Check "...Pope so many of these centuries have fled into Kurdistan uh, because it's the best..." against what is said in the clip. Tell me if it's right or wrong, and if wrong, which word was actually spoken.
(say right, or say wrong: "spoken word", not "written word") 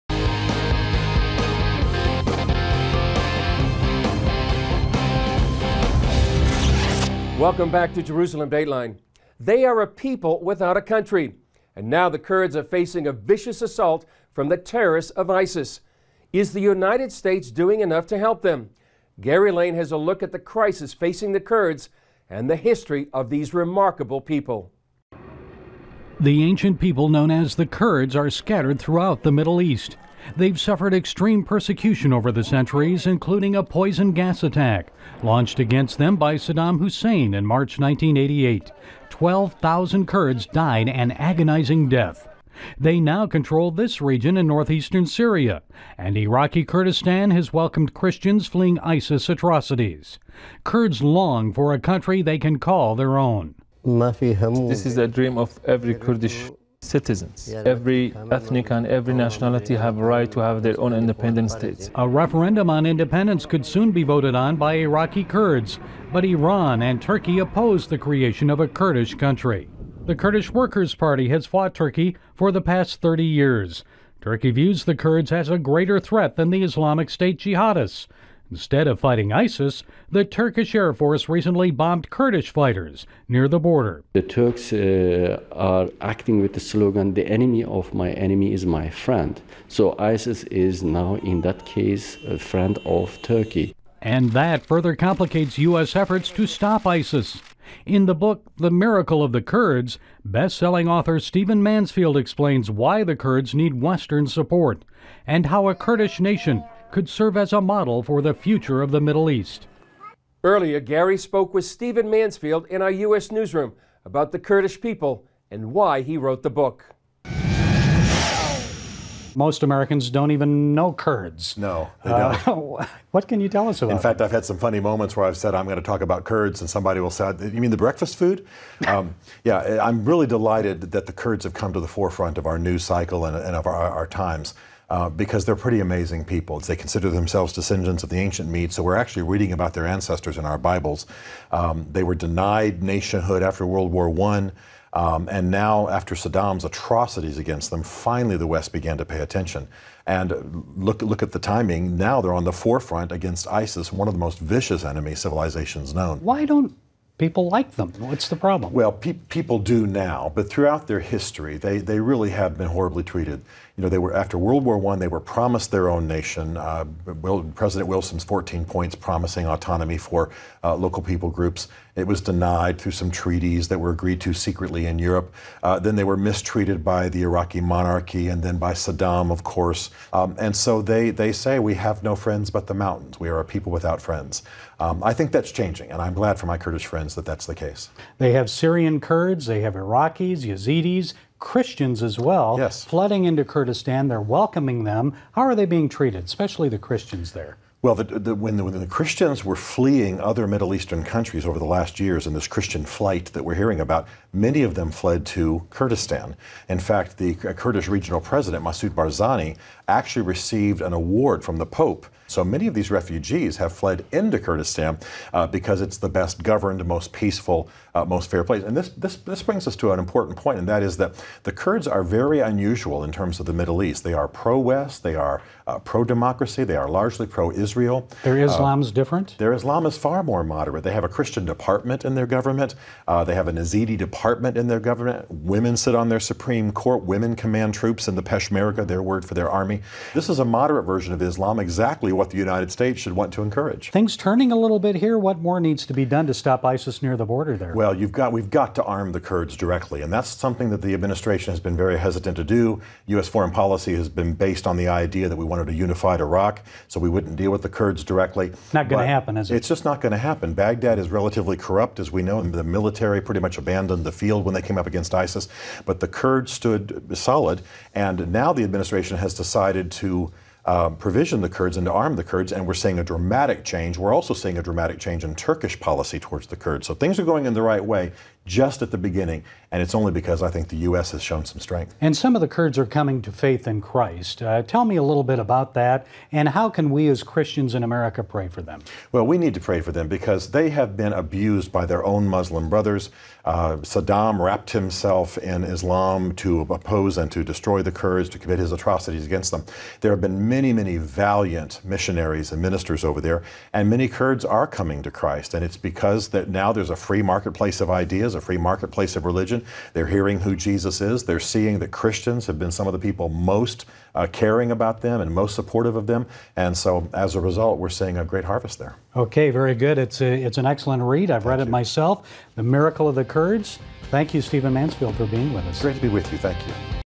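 wrong: "refugees", not "centuries".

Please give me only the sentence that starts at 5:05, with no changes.
And it's because that now there's a free marketplace of ideas is, a free marketplace of religion.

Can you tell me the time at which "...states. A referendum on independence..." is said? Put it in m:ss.
1:01.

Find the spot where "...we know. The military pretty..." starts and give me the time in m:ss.
4:22.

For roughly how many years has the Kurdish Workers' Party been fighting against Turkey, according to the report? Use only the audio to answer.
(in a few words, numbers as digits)
30 years.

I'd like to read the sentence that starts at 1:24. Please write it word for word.
The Turks uh, are acting with the slogan, the enemy of my enemy is my friend.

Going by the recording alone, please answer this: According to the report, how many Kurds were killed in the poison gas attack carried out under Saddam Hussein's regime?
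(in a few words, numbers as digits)
12,000.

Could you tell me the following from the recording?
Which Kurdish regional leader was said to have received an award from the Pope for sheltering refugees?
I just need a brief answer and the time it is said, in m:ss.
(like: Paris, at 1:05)
Masoud Barzani, at 3:28.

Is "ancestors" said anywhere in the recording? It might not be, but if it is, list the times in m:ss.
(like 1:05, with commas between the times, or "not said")
2:19.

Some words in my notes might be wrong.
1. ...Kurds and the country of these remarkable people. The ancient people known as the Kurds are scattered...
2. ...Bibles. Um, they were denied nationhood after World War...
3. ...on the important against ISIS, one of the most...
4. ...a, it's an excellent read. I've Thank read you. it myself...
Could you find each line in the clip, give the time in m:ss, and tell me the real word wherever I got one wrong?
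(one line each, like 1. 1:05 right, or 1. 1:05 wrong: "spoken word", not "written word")
1. 0:21 wrong: "history", not "country"
2. 2:20 right
3. 2:32 wrong: "forefront", not "important"
4. 5:20 right.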